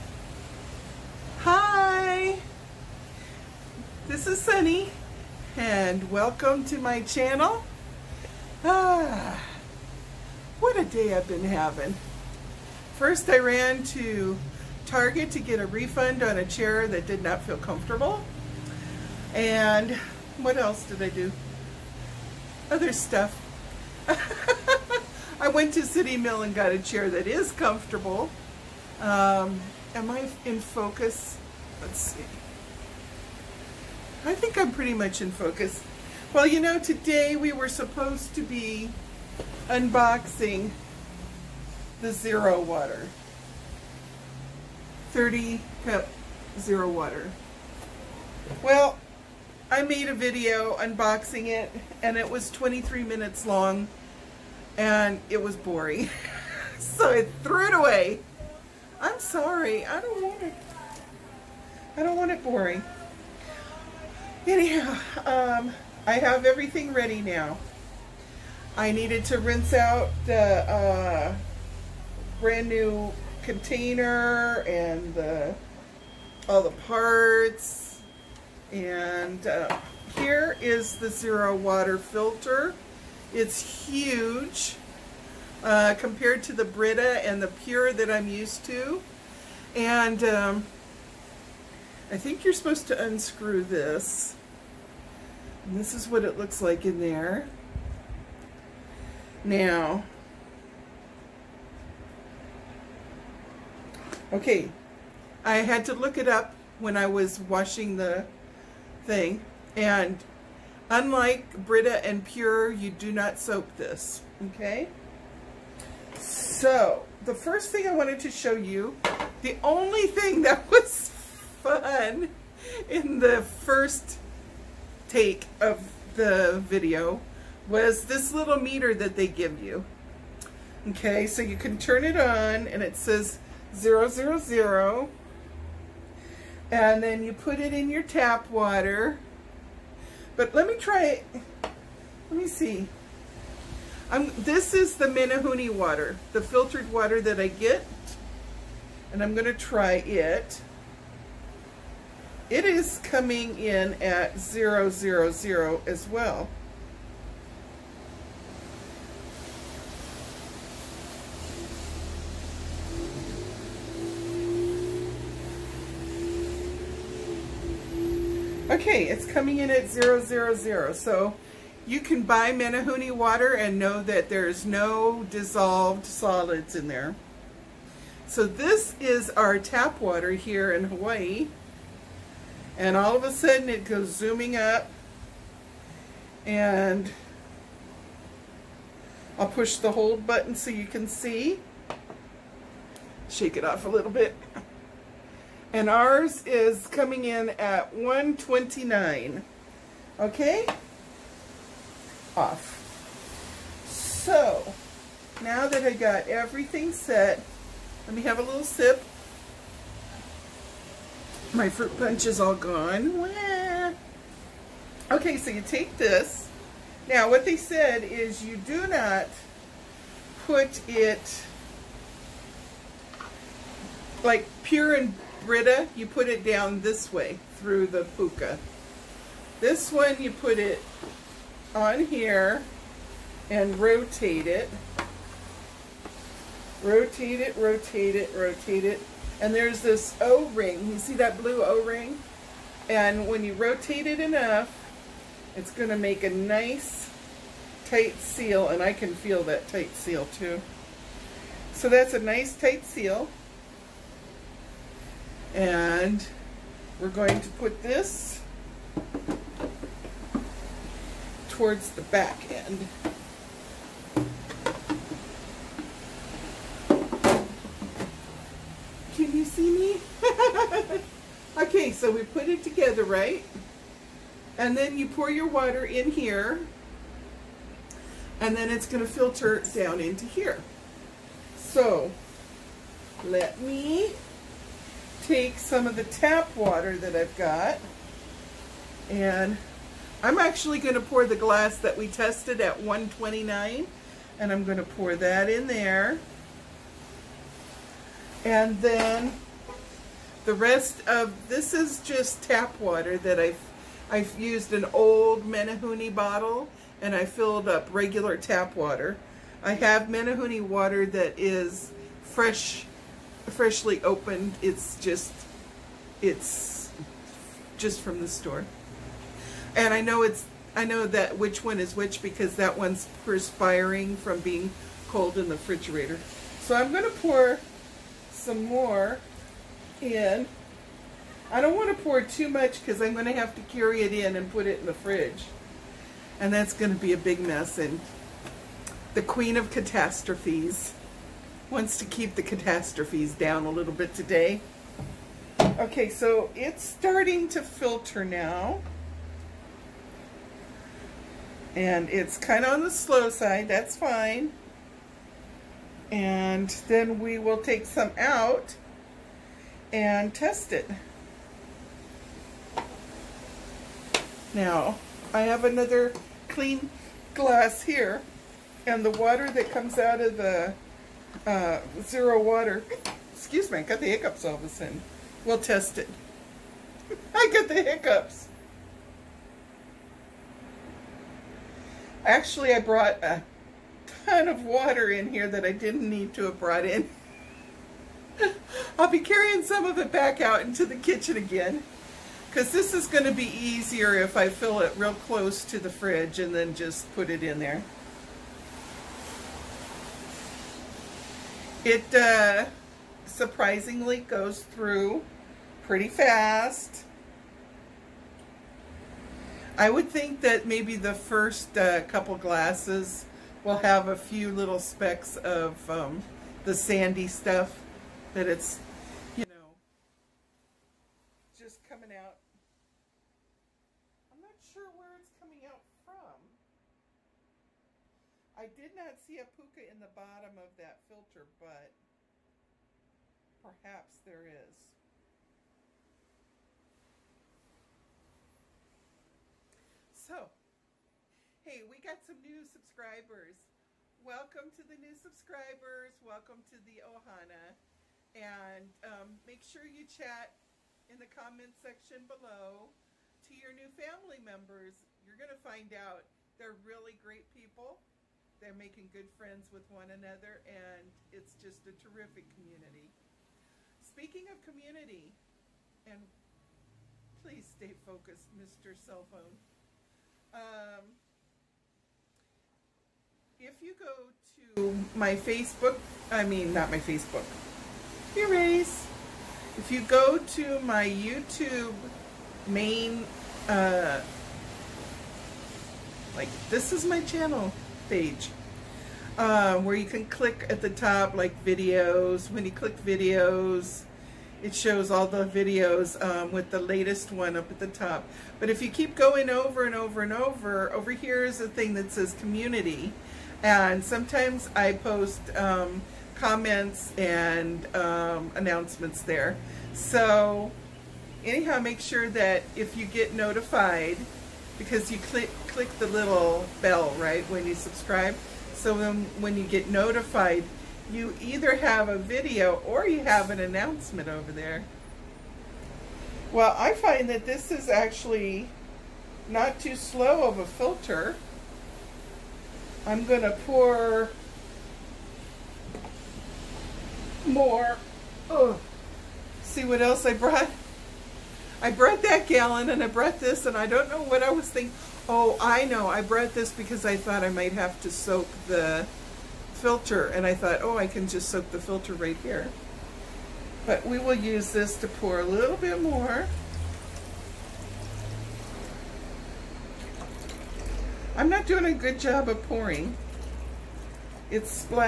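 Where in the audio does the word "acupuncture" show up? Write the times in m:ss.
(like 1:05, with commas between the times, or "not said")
not said.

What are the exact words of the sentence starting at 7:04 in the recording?
I'm not sure where it's coming out from.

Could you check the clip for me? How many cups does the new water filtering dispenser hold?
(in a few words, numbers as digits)
30.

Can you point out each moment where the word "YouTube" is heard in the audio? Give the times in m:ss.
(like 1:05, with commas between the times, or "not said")
8:01.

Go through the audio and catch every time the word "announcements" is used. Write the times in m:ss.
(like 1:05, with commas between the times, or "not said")
8:28, 8:43.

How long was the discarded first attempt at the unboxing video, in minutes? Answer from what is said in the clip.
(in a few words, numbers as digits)
23.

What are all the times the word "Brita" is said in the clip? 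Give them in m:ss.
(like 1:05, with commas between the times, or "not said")
1:26, 1:51, 3:45.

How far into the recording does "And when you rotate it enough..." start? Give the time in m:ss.
4:02.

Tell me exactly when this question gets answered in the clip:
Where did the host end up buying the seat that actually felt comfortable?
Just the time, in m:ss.
0:25.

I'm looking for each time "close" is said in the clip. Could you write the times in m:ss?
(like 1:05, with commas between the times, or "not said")
6:35.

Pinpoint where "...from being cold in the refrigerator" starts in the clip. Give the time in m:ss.
5:24.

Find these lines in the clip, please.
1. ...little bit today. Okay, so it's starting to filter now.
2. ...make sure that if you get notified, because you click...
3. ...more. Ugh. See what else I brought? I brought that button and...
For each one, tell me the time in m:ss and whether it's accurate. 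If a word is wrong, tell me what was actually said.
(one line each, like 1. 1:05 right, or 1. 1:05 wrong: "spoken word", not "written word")
1. 5:43 right
2. 8:31 right
3. 8:57 wrong: "gallon", not "button".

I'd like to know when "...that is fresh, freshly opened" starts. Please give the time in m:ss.
5:11.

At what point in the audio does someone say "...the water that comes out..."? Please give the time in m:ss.
6:09.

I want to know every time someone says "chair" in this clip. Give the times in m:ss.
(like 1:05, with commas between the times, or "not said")
0:16, 0:26.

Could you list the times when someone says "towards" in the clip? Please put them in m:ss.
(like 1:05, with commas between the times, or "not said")
4:21.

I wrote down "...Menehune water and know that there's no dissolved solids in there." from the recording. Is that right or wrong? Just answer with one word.
right.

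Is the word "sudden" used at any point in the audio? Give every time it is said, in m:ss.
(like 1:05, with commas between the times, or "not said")
3:03, 6:14.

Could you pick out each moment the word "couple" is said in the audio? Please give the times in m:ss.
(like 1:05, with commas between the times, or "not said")
6:52.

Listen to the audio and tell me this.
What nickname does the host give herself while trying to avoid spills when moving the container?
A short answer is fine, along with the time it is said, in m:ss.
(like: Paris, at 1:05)
Queen of catastrophes, at 5:39.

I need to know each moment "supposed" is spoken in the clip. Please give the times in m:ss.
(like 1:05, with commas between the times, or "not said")
0:37, 1:32.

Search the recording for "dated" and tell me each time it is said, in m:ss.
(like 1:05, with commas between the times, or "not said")
not said.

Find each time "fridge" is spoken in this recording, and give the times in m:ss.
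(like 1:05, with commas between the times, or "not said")
5:34, 6:35.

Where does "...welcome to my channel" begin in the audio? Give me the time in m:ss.
0:06.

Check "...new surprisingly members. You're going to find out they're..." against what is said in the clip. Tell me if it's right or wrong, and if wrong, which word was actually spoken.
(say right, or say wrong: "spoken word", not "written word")
wrong: "family", not "surprisingly".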